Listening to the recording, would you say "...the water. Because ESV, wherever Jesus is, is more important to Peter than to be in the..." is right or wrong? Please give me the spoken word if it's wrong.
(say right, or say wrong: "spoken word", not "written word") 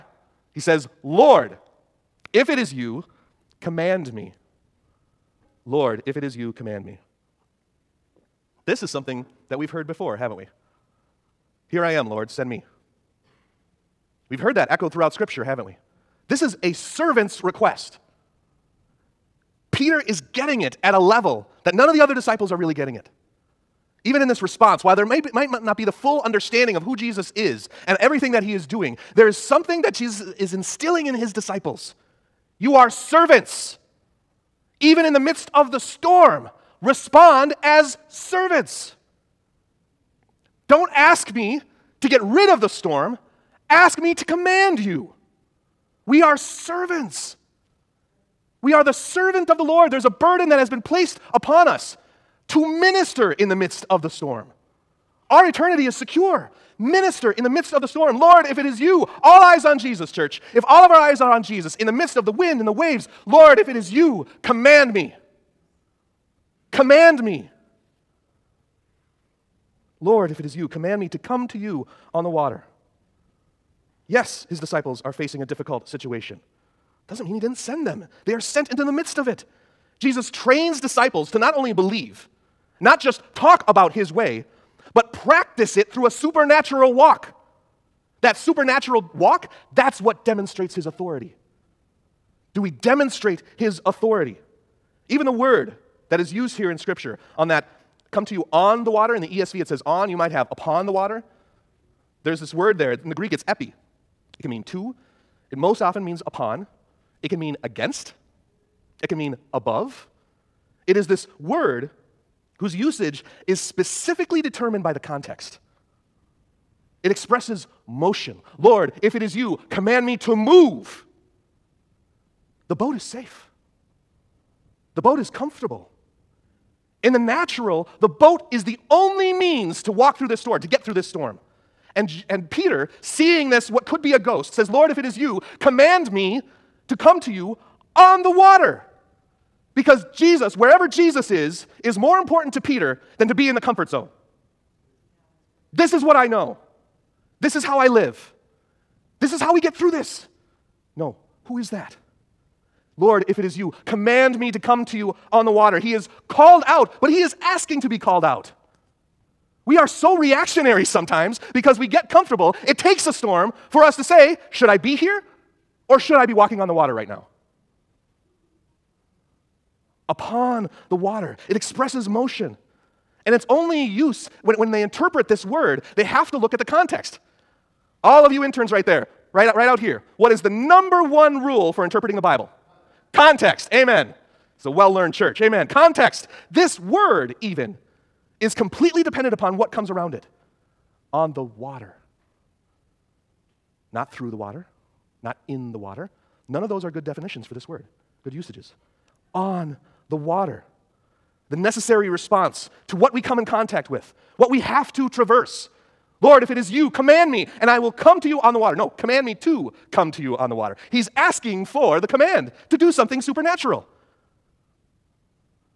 wrong: "Jesus", not "ESV".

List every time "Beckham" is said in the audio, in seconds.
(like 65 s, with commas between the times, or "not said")
not said.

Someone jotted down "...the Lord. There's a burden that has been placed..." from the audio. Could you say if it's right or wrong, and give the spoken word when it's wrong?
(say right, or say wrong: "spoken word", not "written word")
right.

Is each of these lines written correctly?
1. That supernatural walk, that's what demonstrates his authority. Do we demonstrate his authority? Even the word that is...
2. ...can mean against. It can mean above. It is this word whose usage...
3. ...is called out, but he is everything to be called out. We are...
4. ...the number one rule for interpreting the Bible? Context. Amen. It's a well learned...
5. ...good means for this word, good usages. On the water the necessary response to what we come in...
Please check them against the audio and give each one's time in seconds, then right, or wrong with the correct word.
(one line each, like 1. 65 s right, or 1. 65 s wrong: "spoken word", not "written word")
1. 88 s right
2. 107 s right
3. 155 s wrong: "asking", not "everything"
4. 180 s right
5. 196 s wrong: "definitions", not "means".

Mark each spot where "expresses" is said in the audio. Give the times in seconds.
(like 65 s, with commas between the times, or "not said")
117 s, 171 s.